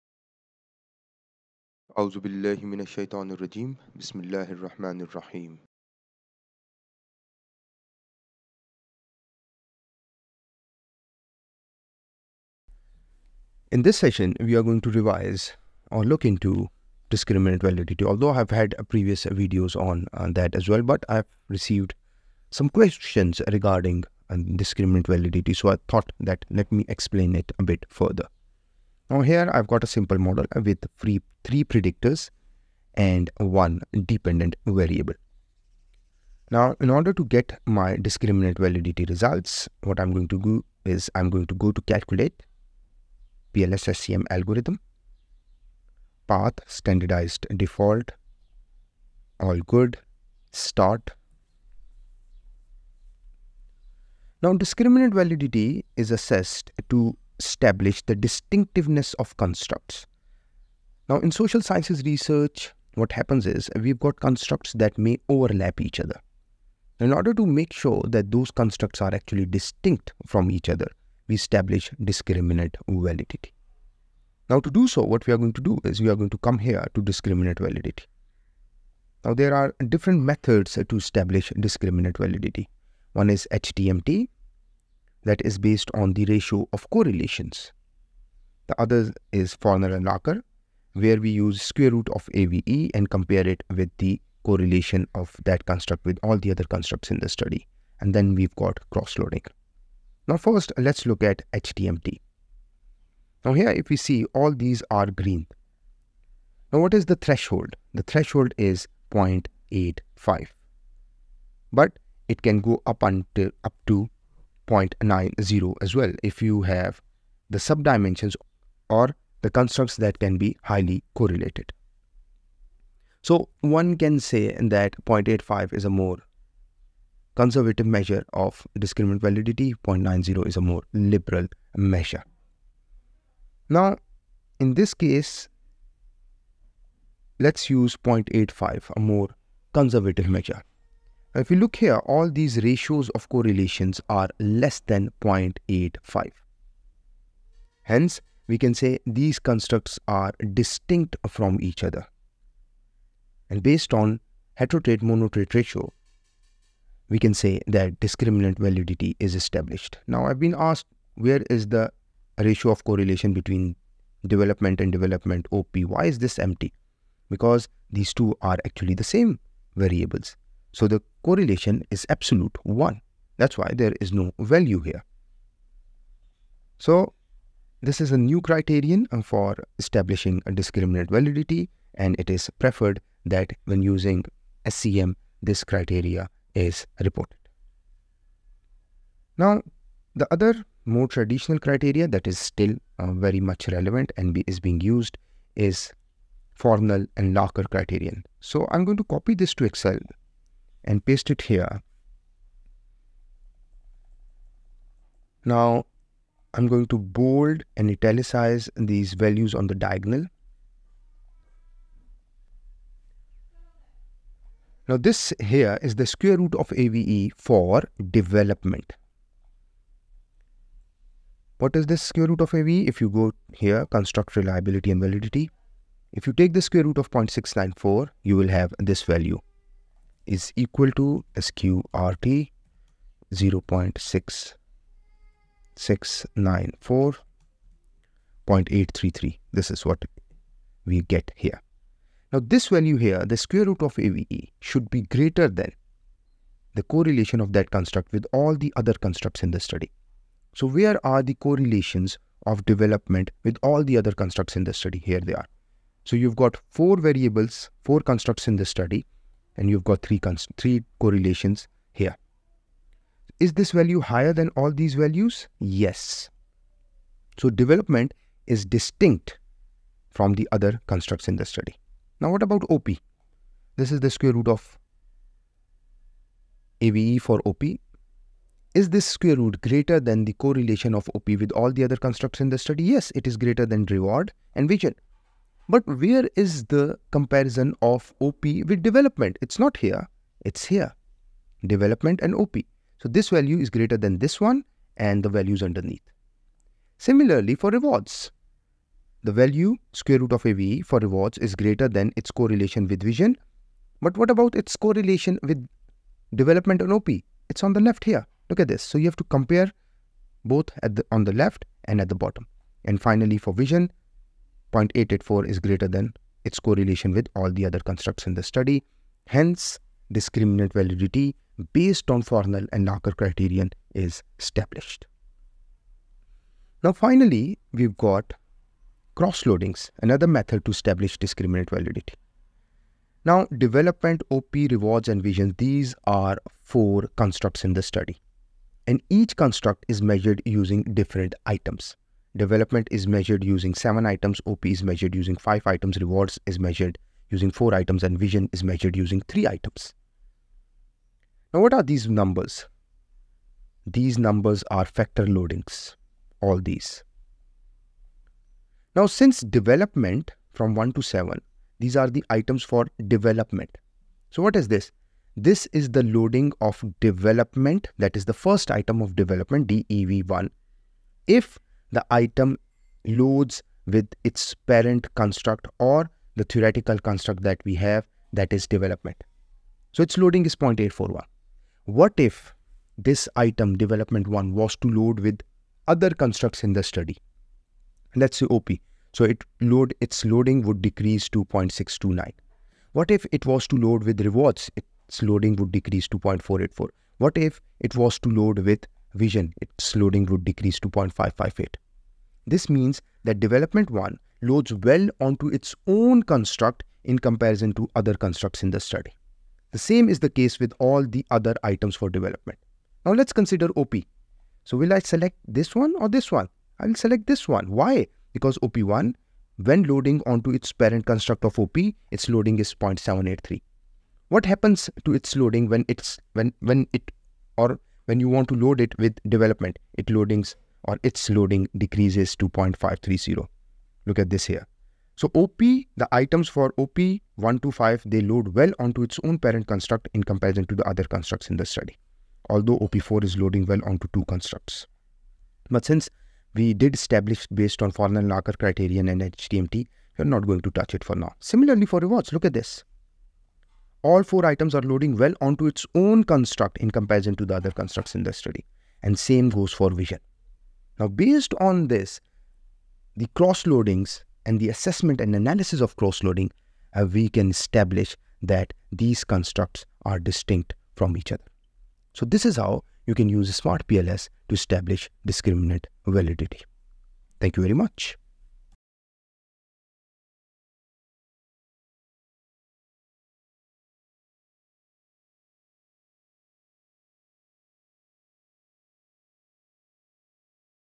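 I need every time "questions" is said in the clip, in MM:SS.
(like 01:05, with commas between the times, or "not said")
00:22.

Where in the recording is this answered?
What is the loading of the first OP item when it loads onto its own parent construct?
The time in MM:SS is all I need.
07:02.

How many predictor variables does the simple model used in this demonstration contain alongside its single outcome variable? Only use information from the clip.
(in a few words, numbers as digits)
3.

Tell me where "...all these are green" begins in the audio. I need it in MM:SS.
01:44.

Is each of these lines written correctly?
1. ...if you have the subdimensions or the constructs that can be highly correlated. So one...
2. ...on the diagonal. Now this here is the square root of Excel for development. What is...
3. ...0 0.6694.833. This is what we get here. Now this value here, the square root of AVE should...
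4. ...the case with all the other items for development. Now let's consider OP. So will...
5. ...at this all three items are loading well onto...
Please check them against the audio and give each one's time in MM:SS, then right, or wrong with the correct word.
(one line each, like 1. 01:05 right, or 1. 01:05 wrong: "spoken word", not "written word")
1. 01:56 right
2. 03:29 wrong: "AVE", not "Excel"
3. 03:53 right
4. 06:50 right
5. 07:32 wrong: "four", not "three".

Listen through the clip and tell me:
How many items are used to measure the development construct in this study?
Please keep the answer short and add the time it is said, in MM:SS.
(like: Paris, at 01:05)
7, at 05:43.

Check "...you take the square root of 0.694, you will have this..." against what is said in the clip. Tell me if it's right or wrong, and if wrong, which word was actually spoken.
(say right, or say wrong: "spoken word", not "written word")
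right.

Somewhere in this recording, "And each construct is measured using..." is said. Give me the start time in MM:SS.
05:38.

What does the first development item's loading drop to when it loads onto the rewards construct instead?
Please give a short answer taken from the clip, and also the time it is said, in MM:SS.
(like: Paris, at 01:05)
0.484, at 06:36.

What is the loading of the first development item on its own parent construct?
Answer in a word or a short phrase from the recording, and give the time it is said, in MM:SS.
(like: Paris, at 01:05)
0.841, at 06:20.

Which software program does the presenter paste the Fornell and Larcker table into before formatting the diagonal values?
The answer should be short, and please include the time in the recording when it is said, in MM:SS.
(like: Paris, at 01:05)
Excel, at 03:19.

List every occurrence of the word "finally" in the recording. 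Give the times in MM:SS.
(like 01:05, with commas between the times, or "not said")
05:13, 05:26.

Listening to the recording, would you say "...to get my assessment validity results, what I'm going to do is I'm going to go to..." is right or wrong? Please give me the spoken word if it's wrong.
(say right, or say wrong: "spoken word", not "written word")
wrong: "discriminant", not "assessment".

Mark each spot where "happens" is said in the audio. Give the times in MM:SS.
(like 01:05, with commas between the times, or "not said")
01:03, 07:04.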